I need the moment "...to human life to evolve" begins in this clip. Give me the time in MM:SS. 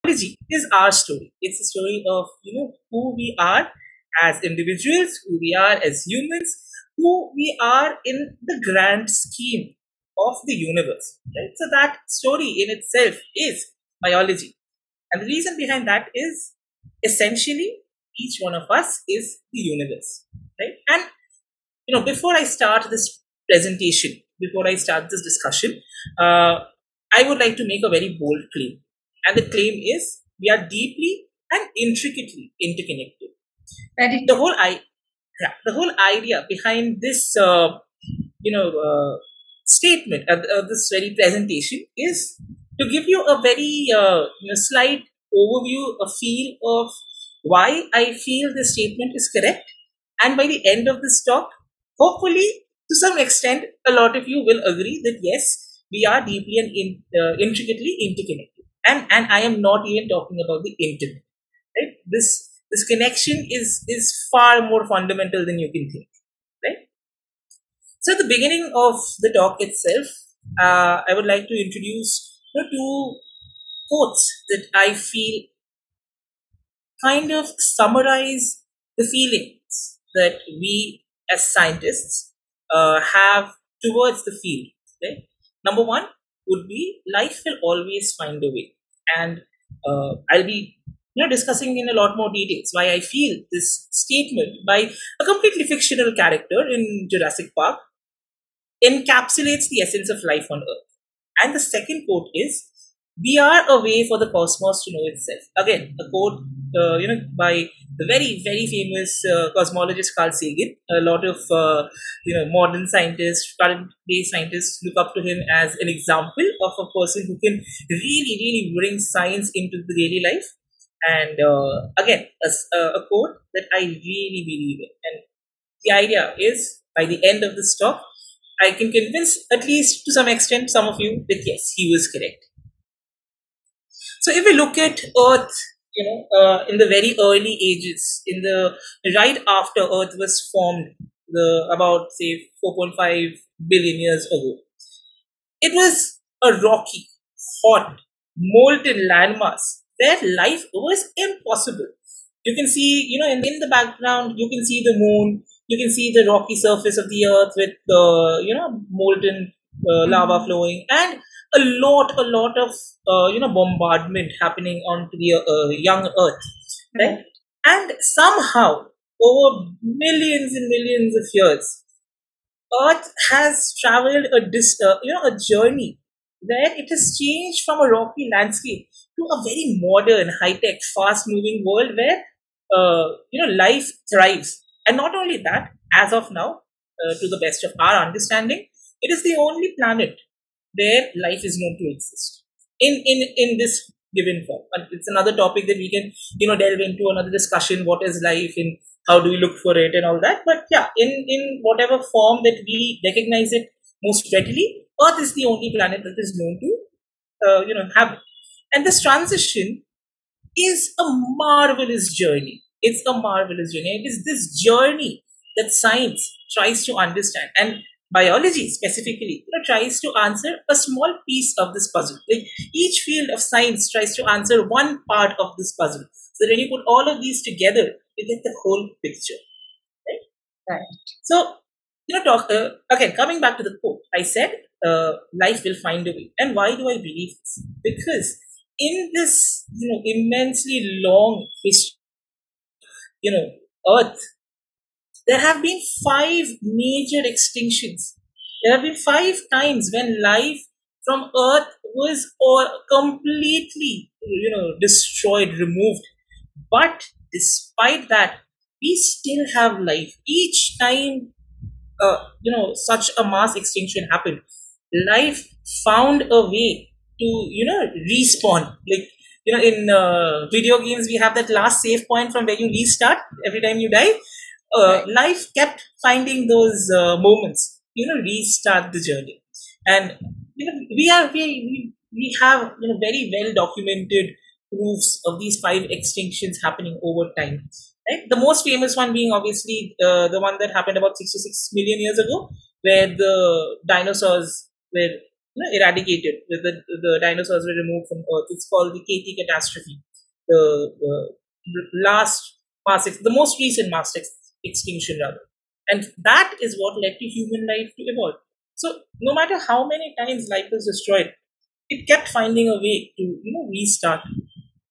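05:07.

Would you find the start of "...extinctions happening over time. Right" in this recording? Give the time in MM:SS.
04:45.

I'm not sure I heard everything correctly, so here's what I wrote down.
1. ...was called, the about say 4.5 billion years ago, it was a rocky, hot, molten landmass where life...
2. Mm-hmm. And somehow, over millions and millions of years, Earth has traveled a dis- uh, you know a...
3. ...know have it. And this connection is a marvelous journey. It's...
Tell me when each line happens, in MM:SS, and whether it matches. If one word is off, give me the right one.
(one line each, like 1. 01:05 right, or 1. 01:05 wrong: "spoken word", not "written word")
1. 02:20 wrong: "formed", not "called"
2. 02:47 right
3. 03:27 wrong: "transition", not "connection".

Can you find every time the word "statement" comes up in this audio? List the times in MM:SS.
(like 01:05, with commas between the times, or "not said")
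00:39, 00:48, 01:33.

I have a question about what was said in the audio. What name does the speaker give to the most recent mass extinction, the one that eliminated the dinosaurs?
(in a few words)
KT catastrophe.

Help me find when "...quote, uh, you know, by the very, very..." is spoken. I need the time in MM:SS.
01:46.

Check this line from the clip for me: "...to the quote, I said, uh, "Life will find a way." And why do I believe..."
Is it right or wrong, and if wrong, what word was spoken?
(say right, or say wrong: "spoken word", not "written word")
right.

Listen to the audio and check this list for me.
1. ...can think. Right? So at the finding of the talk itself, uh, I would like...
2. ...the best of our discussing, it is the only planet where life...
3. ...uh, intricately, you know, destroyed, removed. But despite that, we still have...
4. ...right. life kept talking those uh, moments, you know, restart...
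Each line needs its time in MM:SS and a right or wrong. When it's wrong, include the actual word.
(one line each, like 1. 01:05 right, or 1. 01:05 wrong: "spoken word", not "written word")
1. 01:05 wrong: "beginning", not "finding"
2. 03:07 wrong: "understanding", not "discussing"
3. 04:12 wrong: "completely", not "intricately"
4. 04:34 wrong: "finding", not "talking".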